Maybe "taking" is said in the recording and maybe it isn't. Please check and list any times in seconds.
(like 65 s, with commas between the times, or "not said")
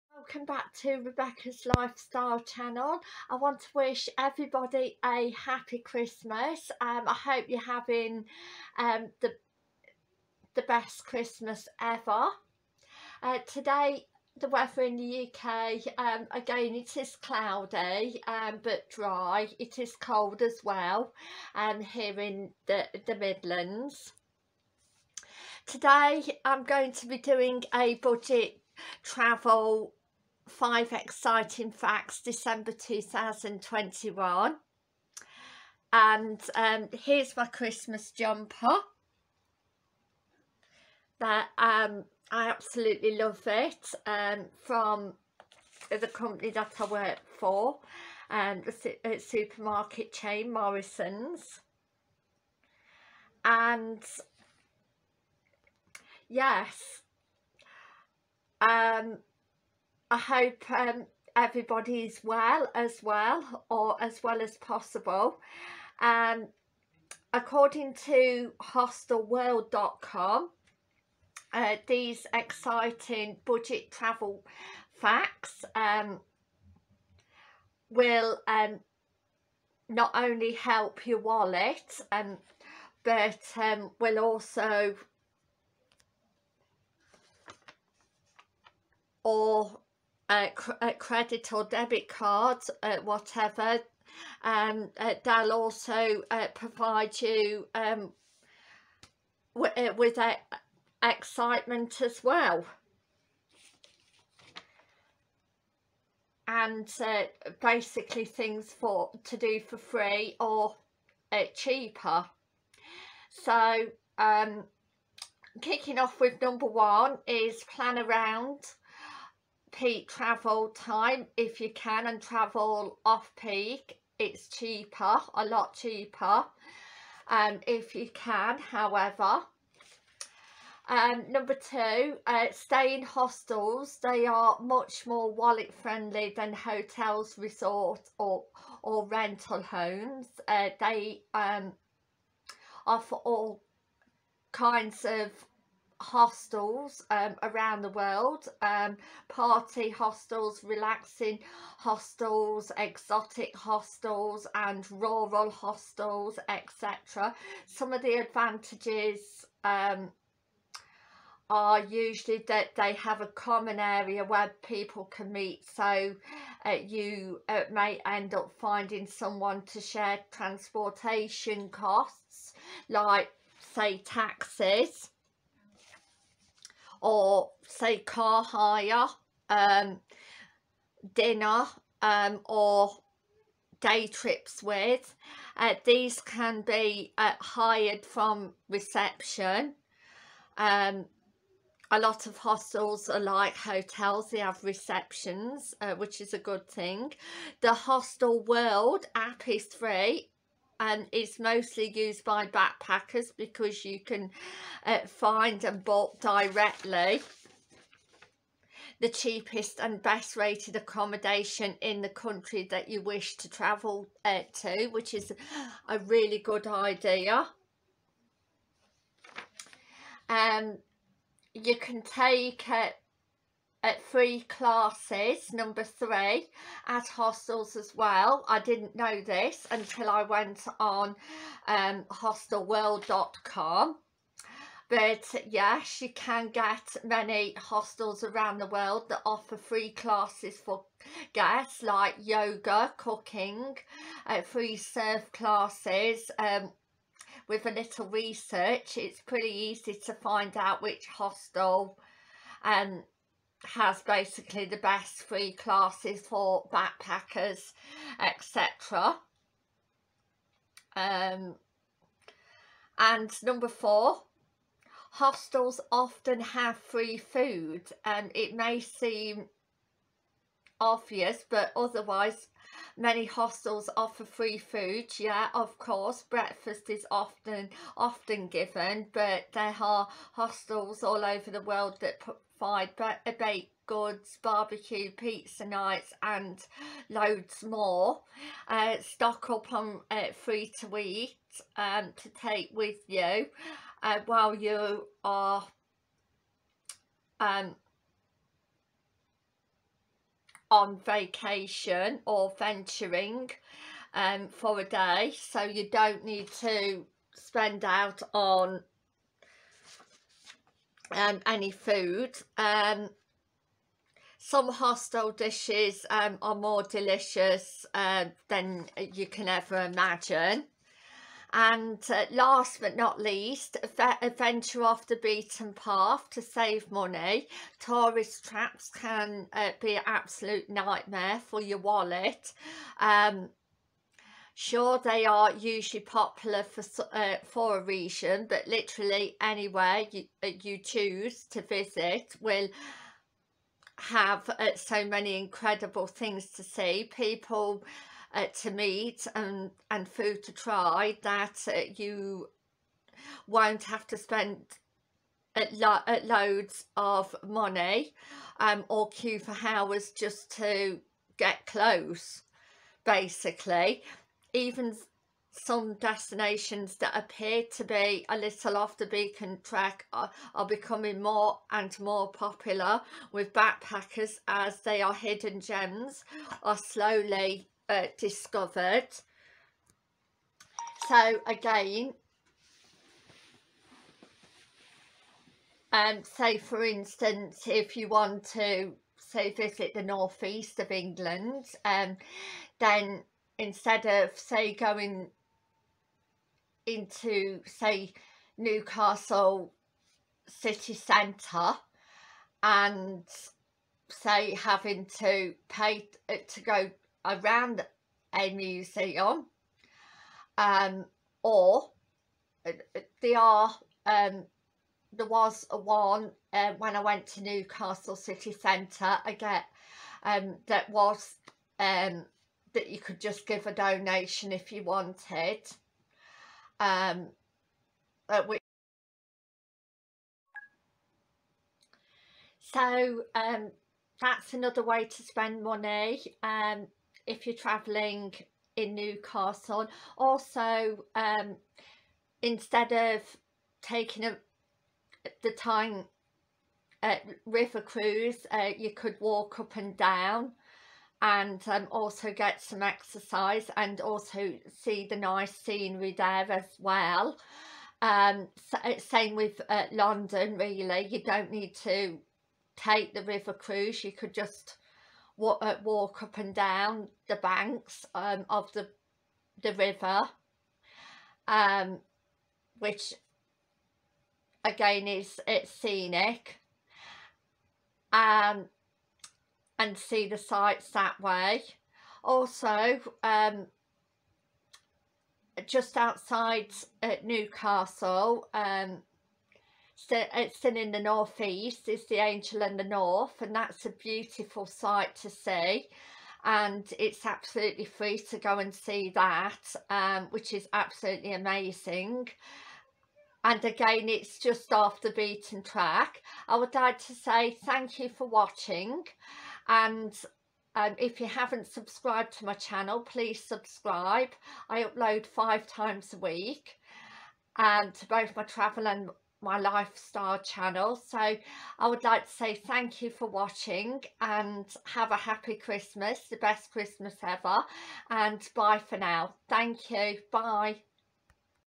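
443 s.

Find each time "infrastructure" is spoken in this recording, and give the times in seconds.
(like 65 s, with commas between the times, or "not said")
not said.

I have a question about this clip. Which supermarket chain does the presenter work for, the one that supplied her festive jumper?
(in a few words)
Morrisons.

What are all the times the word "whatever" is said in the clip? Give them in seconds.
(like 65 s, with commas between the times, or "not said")
93 s.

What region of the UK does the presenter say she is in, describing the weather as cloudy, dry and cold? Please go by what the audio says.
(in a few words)
the Midlands.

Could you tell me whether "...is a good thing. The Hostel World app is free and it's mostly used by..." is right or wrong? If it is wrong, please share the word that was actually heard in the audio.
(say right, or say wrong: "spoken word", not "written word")
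right.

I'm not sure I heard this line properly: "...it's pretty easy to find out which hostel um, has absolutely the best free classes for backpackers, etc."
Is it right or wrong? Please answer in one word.
wrong.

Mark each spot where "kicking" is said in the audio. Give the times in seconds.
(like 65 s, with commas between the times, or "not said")
115 s.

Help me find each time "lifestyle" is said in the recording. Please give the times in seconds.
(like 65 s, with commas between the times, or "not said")
1 s, 519 s.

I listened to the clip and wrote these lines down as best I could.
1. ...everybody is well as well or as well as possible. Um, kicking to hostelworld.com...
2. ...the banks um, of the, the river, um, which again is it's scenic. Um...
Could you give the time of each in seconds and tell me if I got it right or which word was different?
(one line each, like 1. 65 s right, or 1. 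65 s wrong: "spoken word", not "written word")
1. 61 s wrong: "according", not "kicking"
2. 467 s right.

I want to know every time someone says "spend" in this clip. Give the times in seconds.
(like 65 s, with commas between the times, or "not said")
307 s, 354 s, 435 s.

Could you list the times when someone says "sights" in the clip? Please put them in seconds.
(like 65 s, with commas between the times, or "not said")
480 s, 494 s.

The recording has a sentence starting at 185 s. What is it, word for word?
Uh, these can be uh, hired from reception.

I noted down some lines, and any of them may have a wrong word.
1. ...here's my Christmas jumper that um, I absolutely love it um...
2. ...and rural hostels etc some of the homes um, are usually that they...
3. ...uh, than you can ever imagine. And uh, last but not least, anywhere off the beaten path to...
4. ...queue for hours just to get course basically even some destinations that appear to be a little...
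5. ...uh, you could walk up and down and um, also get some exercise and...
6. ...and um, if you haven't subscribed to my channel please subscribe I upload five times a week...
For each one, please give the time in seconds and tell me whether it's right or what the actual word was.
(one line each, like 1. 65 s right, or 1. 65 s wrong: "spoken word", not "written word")
1. 37 s right
2. 154 s wrong: "advantages", not "homes"
3. 317 s wrong: "venture", not "anywhere"
4. 359 s wrong: "close", not "course"
5. 448 s right
6. 509 s right.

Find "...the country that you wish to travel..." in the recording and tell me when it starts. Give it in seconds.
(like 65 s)
212 s.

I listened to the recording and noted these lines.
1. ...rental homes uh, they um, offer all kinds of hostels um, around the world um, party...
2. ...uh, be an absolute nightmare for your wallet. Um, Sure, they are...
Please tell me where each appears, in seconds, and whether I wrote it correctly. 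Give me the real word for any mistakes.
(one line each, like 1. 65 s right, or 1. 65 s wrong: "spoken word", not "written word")
1. 139 s right
2. 329 s right.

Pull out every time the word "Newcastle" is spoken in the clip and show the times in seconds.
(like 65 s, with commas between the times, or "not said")
398 s, 417 s, 438 s, 487 s.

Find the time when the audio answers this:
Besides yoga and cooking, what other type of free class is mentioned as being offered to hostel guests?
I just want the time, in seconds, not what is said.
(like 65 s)
244 s.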